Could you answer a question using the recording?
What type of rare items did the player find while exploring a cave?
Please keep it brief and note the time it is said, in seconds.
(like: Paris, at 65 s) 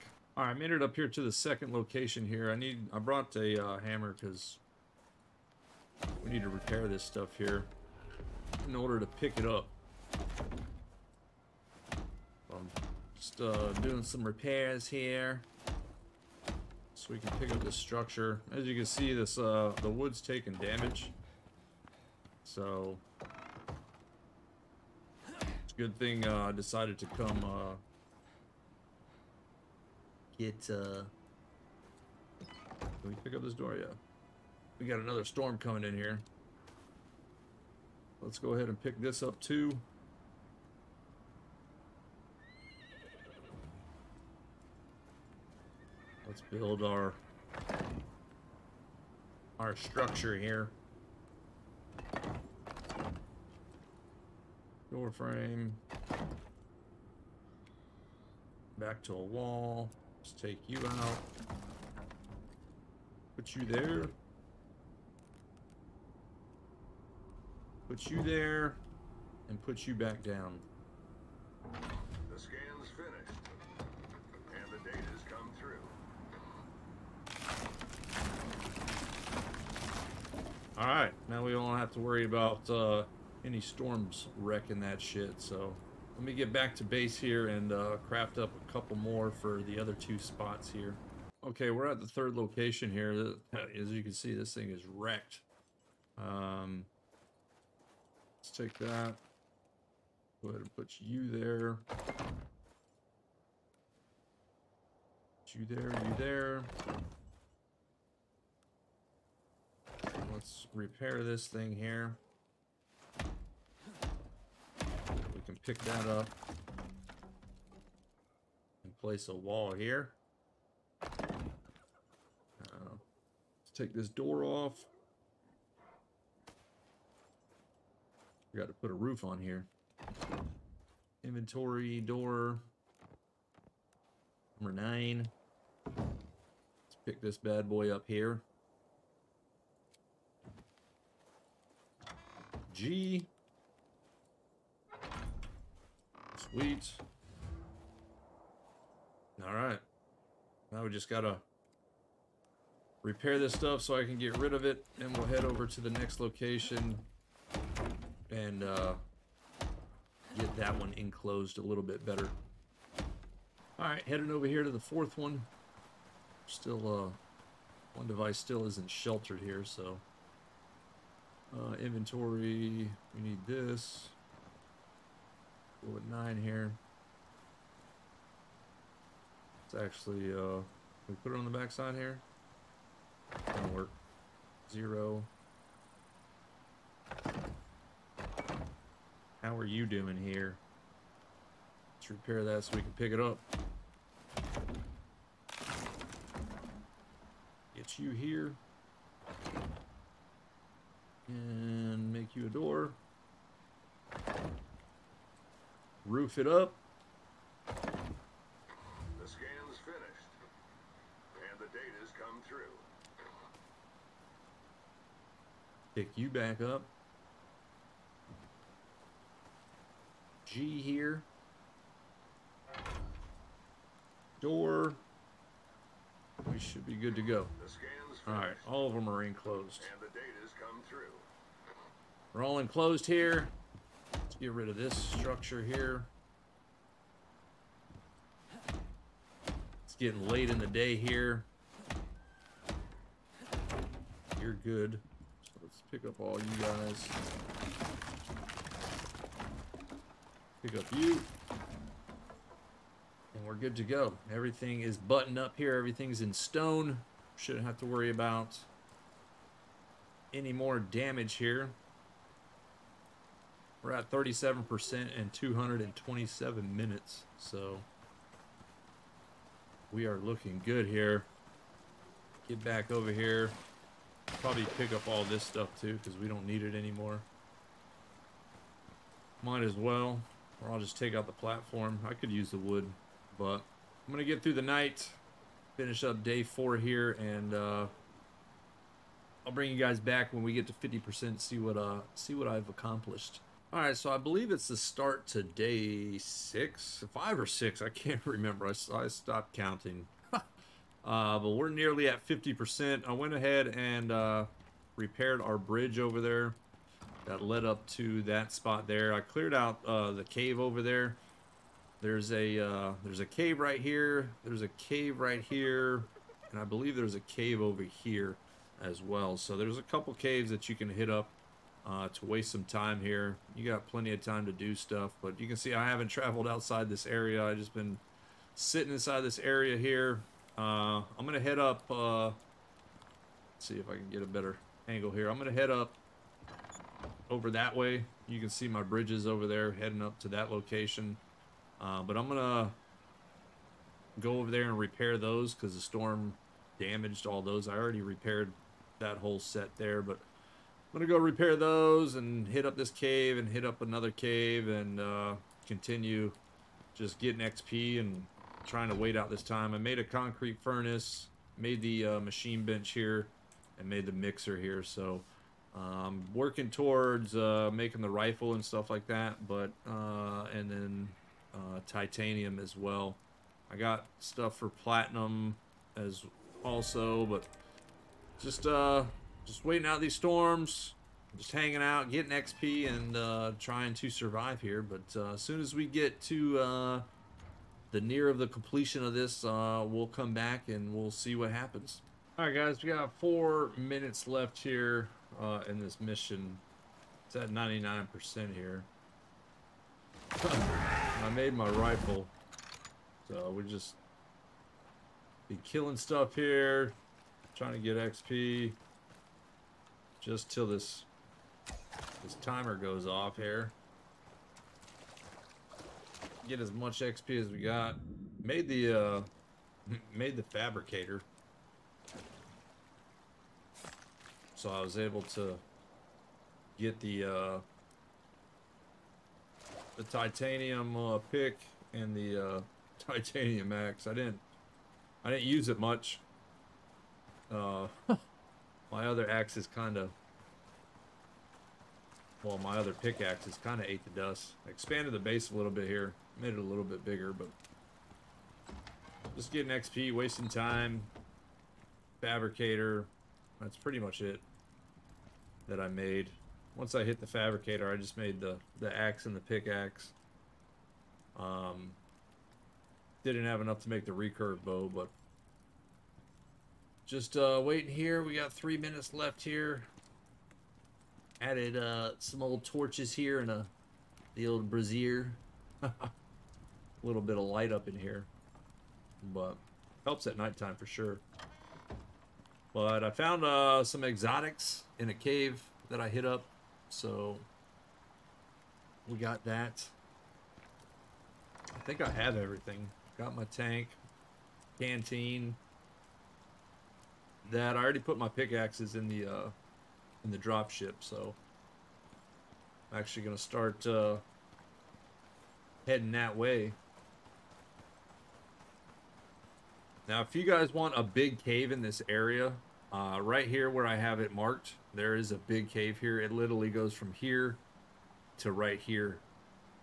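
exotics, at 484 s.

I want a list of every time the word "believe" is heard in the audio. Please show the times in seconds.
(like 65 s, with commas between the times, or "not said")
294 s, 316 s.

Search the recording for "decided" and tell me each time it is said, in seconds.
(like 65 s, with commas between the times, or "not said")
26 s.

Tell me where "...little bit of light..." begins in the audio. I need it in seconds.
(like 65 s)
477 s.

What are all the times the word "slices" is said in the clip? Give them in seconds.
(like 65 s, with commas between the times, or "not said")
not said.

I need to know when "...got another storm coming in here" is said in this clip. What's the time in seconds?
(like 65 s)
34 s.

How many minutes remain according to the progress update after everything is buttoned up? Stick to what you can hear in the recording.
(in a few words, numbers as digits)
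227.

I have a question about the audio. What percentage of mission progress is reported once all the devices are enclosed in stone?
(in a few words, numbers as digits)
37%.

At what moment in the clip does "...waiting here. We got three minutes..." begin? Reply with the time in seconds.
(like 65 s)
467 s.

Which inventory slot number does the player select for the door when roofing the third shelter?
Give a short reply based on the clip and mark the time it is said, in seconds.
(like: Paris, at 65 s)
9, at 134 s.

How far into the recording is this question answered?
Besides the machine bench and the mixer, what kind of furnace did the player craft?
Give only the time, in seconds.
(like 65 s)
360 s.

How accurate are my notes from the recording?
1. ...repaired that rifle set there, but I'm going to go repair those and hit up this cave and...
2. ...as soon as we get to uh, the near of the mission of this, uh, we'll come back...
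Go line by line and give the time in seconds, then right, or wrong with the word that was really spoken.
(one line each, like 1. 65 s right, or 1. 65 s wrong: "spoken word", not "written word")
1. 348 s wrong: "whole", not "rifle"
2. 385 s wrong: "completion", not "mission".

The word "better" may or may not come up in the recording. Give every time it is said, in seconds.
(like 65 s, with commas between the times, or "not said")
162 s, 334 s.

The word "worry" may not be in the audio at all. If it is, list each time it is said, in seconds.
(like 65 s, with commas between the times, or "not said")
81 s, 257 s.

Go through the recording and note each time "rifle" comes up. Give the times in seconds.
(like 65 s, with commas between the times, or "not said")
368 s, 401 s.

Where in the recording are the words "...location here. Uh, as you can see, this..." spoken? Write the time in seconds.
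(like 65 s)
92 s.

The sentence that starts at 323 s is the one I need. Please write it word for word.
You got plenty of time to do stuff, but you can see I haven't traveled outside this area.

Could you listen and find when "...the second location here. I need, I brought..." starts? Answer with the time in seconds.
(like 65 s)
1 s.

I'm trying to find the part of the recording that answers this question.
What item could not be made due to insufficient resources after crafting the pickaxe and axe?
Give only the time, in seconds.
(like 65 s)
464 s.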